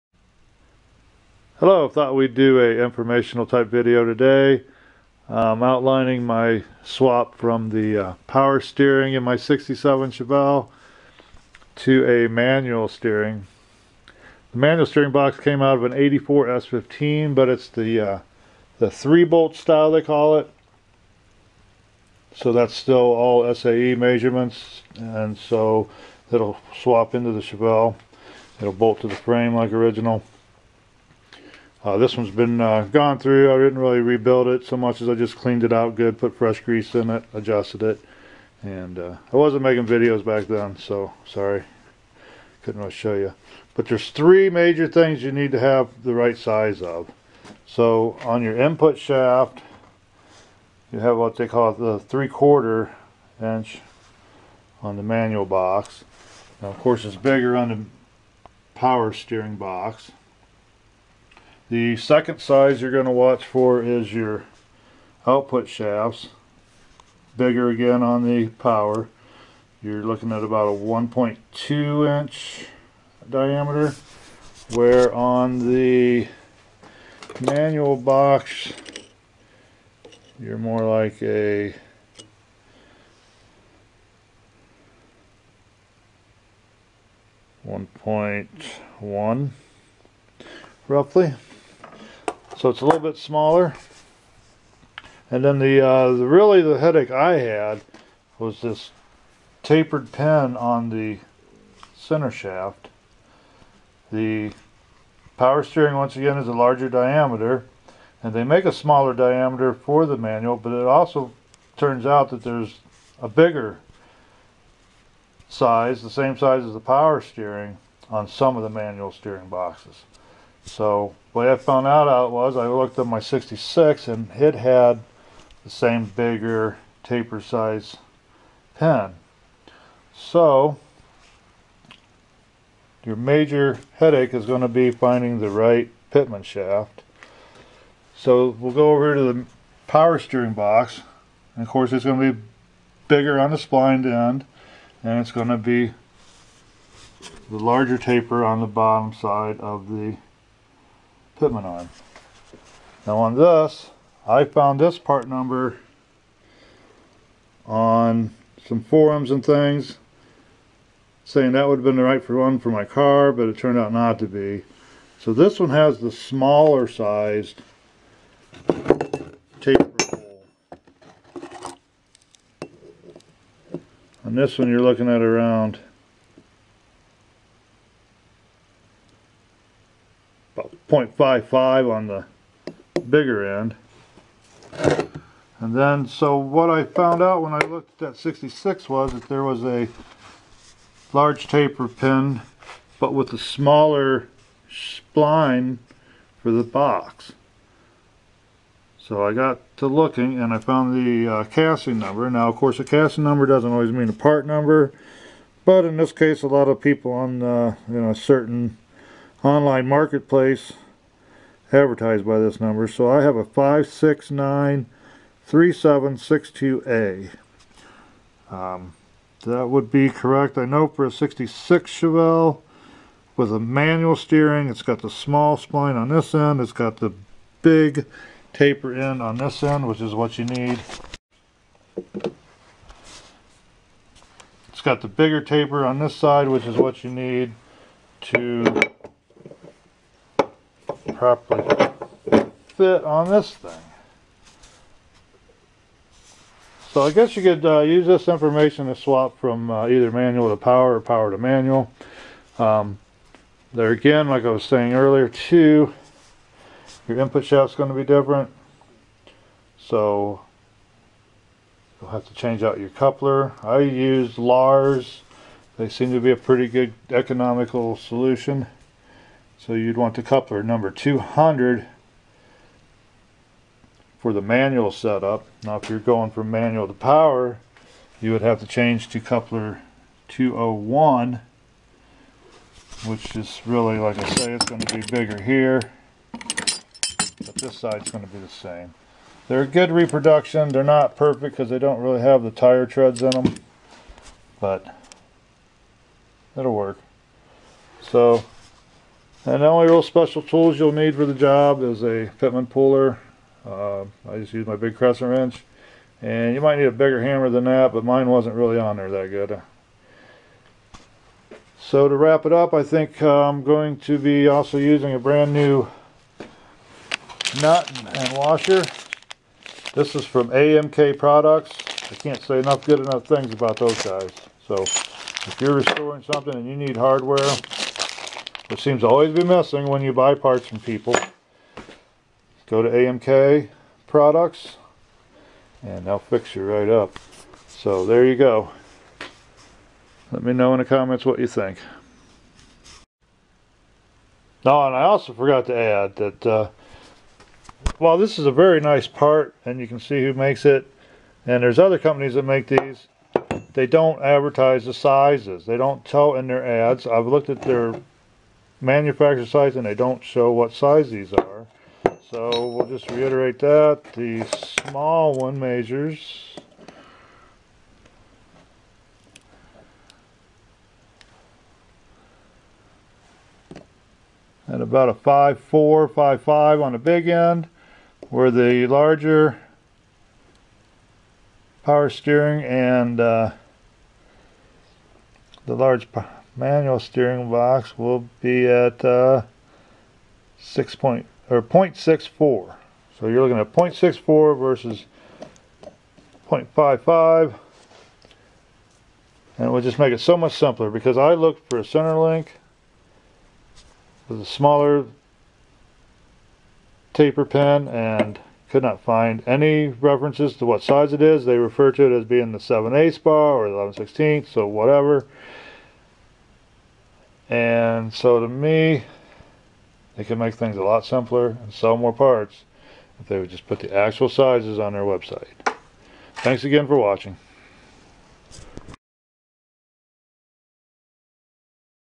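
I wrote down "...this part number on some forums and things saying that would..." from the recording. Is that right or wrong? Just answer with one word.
right.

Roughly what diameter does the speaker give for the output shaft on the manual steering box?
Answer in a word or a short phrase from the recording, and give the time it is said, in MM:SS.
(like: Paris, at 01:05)
1.1 inch, at 01:27.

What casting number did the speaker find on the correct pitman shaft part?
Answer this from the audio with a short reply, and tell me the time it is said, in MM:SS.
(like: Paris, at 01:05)
5693762A, at 03:33.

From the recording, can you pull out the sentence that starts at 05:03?
Uh, I just use my big crescent wrench.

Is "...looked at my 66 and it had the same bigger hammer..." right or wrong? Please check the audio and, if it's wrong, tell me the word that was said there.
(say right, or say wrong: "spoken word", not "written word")
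wrong: "taper", not "hammer".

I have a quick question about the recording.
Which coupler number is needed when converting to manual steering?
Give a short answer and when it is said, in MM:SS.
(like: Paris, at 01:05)
200, at 04:30.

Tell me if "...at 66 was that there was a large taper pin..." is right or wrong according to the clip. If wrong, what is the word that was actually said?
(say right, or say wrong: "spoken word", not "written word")
right.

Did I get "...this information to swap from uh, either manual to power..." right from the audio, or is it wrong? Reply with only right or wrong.
right.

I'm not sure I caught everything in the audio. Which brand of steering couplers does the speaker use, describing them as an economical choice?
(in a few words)
Lares.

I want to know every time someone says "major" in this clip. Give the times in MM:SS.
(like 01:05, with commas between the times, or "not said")
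00:44, 02:13.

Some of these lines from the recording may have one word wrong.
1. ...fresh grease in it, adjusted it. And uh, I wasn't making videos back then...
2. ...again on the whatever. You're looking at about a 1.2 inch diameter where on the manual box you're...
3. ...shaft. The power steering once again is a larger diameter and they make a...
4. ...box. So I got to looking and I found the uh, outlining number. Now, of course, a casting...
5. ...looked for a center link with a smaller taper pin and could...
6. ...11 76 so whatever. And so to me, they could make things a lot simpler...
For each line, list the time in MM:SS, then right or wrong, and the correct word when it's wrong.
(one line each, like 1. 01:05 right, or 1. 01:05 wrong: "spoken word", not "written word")
1. 00:36 right
2. 01:07 wrong: "power", not "whatever"
3. 01:42 right
4. 03:16 wrong: "casting", not "outlining"
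5. 06:41 right
6. 06:53 wrong: "16", not "76".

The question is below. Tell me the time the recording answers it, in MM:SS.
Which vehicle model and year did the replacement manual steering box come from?
00:15.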